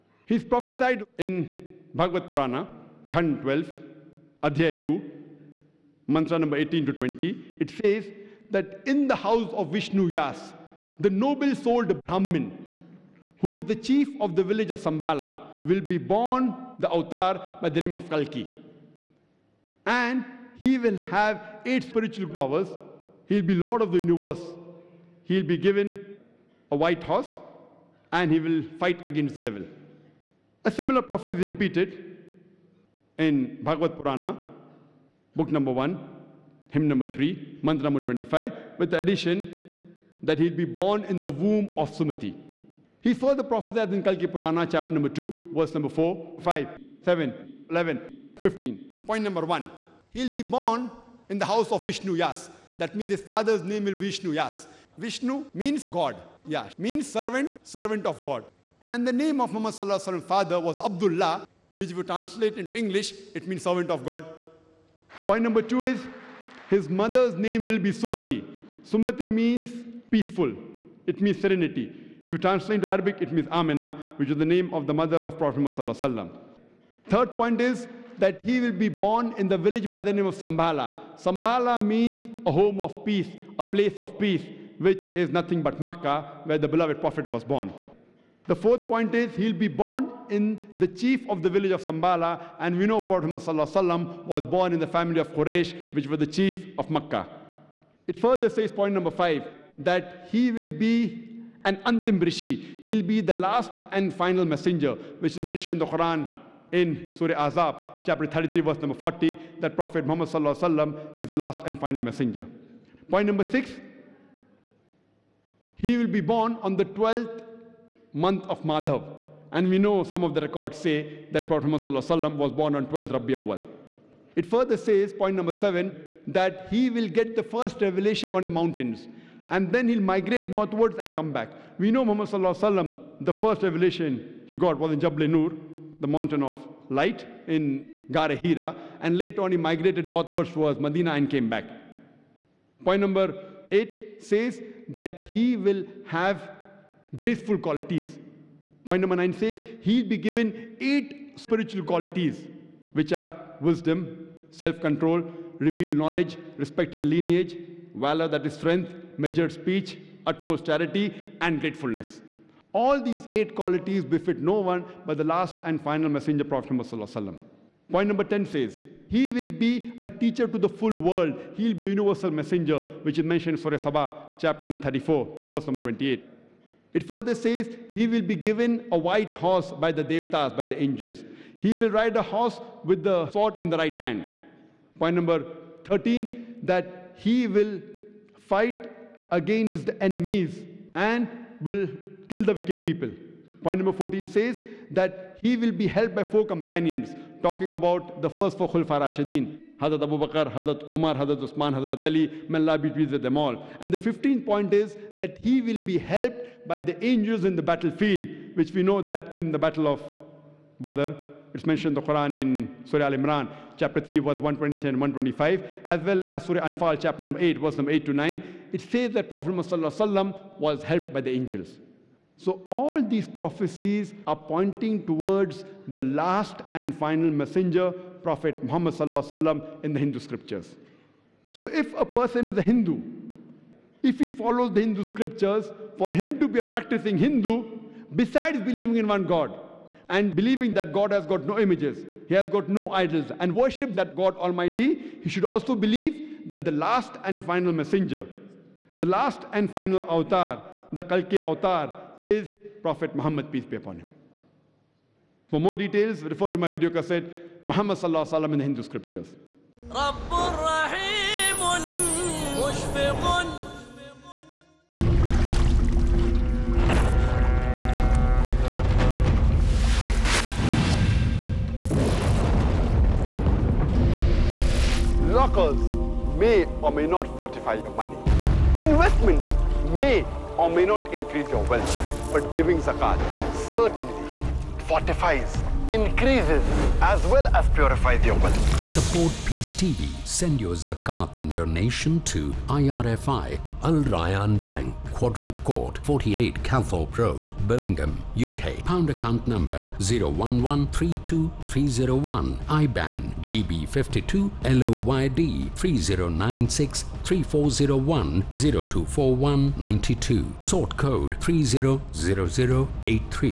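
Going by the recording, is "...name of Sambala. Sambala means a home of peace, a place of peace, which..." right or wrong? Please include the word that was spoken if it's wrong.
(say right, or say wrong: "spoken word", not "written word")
right.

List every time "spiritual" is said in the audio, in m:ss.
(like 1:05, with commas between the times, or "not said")
0:21, 2:31.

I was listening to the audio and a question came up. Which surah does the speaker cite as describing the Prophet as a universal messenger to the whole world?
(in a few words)
Surah Saba.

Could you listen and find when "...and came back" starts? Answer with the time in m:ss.
2:21.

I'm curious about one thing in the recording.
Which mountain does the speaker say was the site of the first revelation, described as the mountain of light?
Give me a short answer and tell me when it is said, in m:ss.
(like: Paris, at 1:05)
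Jabal Nur, at 2:14.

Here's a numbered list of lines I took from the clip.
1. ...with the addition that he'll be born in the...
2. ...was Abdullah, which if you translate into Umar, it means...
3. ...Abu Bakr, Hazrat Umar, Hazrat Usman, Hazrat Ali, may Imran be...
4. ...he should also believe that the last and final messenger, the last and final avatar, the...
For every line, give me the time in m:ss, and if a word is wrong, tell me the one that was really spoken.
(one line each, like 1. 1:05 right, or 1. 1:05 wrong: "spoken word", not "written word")
1. 0:38 right
2. 1:00 wrong: "English", not "Umar"
3. 3:20 wrong: "Allah", not "Imran"
4. 4:05 right.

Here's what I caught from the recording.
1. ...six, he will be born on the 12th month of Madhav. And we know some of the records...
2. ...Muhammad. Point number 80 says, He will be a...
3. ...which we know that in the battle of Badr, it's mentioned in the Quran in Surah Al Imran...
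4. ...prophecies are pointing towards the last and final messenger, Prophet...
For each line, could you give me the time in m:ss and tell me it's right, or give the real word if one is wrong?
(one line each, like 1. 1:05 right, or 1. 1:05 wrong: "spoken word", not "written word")
1. 1:53 right
2. 2:46 wrong: "10", not "80"
3. 3:28 right
4. 3:43 right.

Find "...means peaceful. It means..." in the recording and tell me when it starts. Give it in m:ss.
1:09.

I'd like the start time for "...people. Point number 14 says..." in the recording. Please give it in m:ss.
3:12.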